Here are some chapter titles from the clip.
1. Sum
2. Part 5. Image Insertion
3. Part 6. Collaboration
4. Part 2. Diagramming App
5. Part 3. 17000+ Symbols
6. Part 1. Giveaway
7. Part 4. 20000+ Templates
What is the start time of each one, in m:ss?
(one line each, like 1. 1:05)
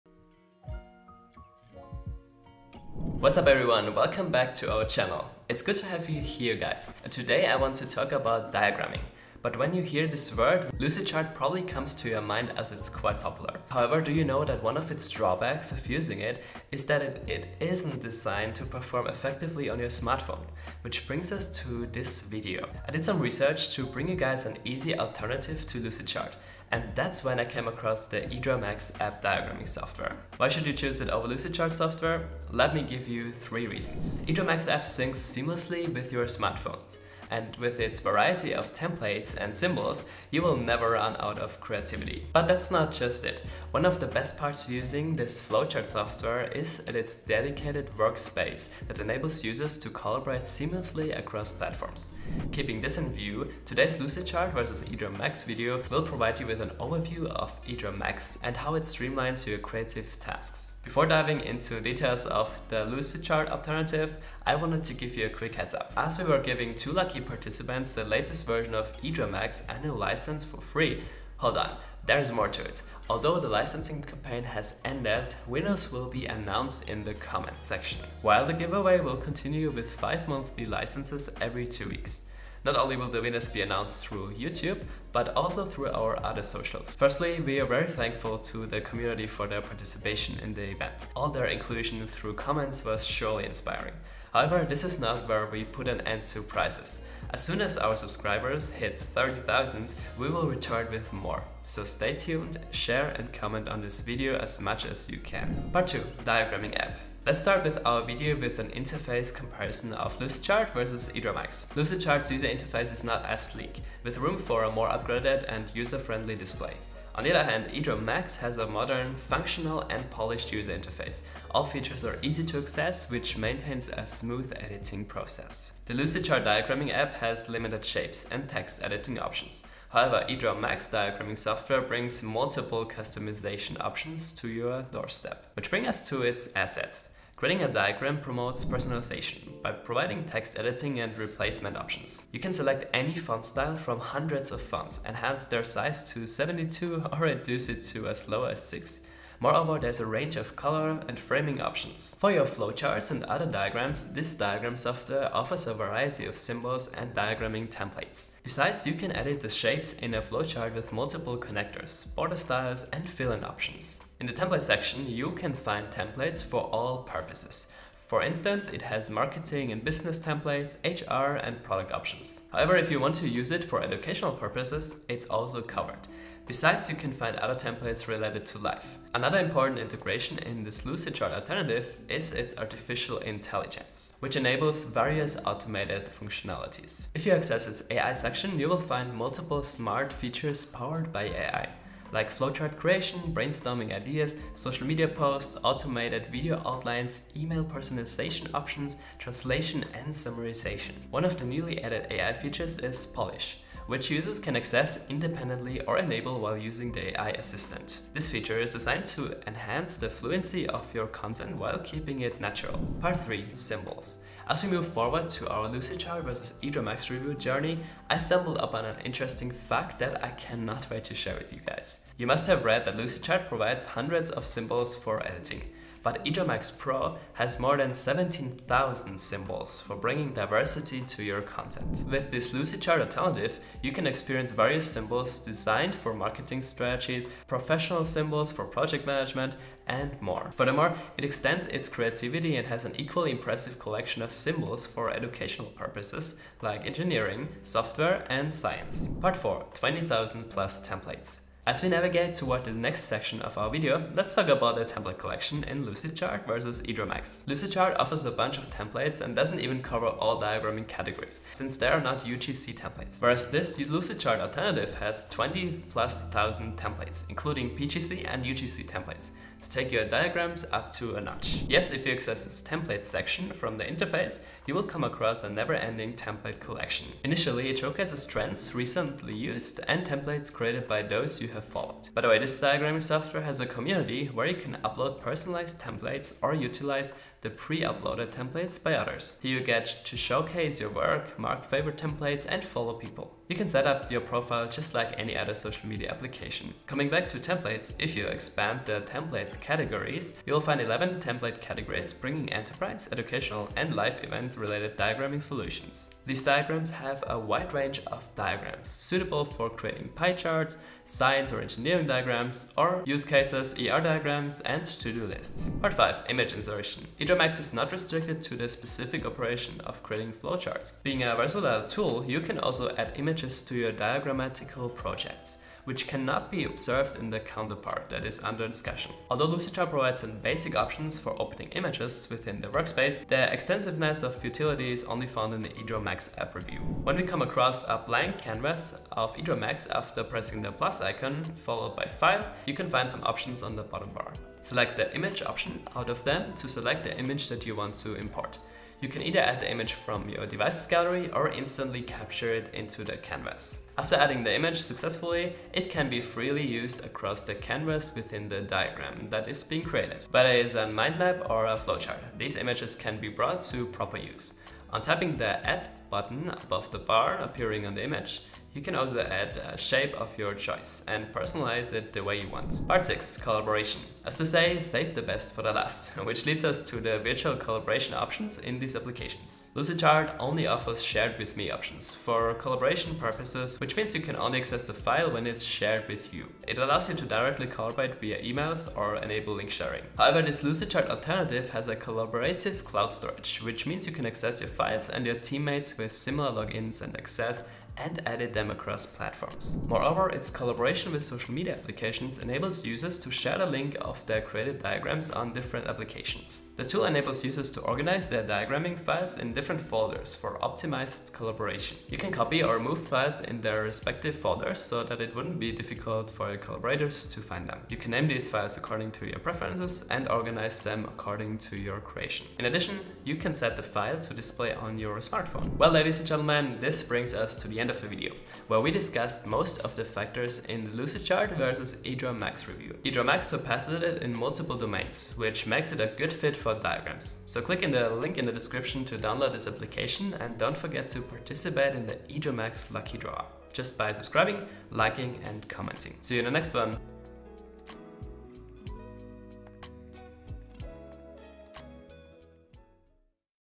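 1. 7:06
2. 5:16
3. 6:13
4. 1:46
5. 3:33
6. 1:00
7. 4:10.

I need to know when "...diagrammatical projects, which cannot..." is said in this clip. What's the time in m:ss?
5:23.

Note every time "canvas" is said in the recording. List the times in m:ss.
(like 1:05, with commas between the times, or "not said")
5:38, 5:53, 5:57.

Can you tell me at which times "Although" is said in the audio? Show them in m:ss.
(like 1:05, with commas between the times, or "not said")
1:13, 5:29.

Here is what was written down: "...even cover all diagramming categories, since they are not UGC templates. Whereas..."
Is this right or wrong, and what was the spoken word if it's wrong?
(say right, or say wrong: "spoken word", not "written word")
right.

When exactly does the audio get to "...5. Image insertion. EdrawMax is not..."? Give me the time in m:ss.
5:15.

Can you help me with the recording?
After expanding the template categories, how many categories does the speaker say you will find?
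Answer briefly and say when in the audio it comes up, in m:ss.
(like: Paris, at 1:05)
11, at 5:00.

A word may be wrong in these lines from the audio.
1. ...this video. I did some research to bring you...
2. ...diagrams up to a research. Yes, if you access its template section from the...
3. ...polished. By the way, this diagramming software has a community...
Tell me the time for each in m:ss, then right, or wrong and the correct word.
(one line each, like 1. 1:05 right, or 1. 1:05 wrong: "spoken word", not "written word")
1. 0:21 right
2. 4:30 wrong: "notch", not "research"
3. 4:41 wrong: "followed", not "polished".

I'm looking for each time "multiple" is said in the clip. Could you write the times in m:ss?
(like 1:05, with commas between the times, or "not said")
2:12, 2:40, 3:09, 7:14.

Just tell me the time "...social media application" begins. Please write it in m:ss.
4:55.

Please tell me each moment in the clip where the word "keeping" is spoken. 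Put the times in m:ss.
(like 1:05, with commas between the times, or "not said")
0:52, 3:31.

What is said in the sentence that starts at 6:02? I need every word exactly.
These images can be brought to proper use.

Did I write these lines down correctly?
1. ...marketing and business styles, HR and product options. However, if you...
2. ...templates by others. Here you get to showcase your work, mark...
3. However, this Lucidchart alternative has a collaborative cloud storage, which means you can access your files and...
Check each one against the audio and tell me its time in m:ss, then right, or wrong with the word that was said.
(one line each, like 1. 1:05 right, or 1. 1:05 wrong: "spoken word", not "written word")
1. 2:49 wrong: "templates", not "styles"
2. 4:48 right
3. 6:30 right.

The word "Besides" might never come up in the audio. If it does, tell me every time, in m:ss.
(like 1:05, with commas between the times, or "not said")
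2:38, 2:56.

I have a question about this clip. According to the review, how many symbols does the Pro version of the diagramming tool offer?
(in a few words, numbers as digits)
17,000.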